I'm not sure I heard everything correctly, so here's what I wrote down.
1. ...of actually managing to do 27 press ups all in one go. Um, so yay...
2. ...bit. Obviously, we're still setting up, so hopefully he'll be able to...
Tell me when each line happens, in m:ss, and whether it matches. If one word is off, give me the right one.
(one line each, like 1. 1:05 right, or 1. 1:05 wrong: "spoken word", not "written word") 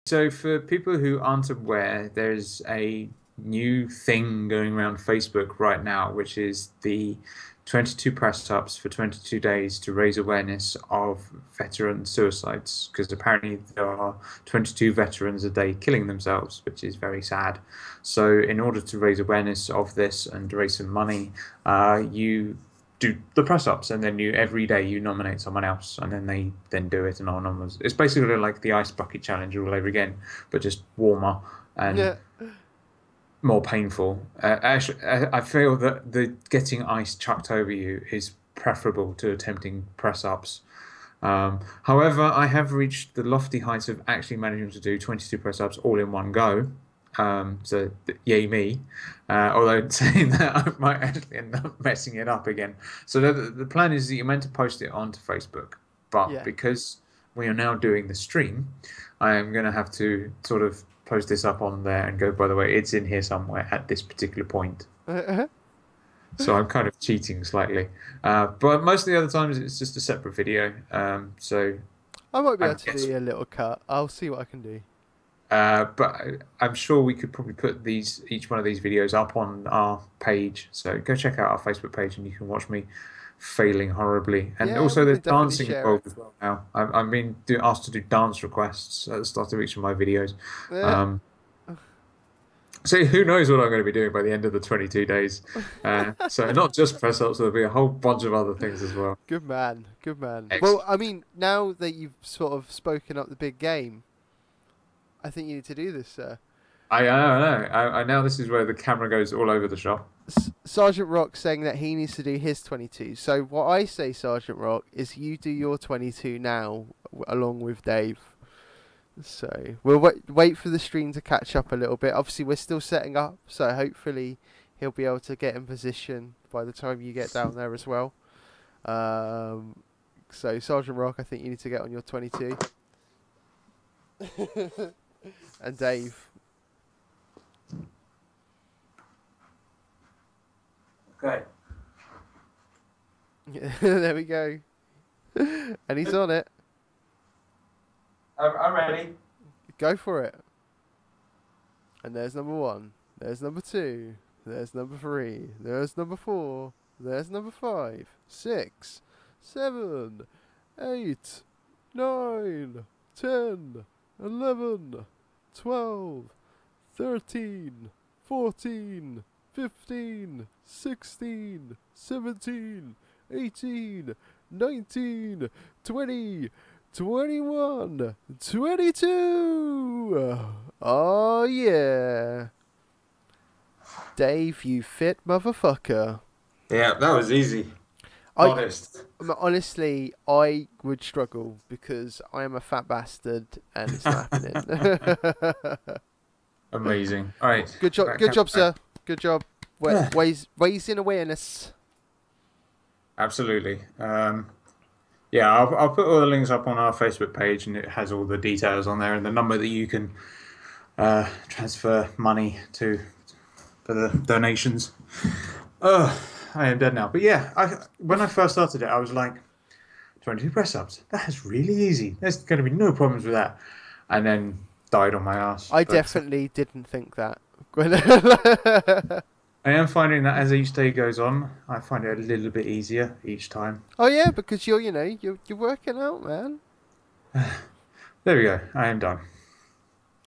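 1. 0:43 wrong: "22", not "27"
2. 2:01 right.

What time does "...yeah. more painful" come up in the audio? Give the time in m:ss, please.
0:31.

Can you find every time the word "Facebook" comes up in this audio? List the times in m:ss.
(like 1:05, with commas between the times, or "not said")
0:04, 0:55, 1:21, 3:26.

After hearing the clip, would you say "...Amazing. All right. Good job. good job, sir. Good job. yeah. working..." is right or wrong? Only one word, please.
wrong.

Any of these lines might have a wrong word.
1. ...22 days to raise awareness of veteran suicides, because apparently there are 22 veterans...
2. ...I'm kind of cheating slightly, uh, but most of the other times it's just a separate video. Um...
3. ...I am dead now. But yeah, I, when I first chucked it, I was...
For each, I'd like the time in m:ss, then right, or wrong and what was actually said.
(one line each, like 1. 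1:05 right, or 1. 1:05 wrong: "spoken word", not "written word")
1. 0:08 right
2. 1:06 right
3. 3:36 wrong: "started", not "chucked".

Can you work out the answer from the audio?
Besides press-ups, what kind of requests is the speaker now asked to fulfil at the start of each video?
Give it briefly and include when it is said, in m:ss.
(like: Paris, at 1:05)
Dance requests, at 1:27.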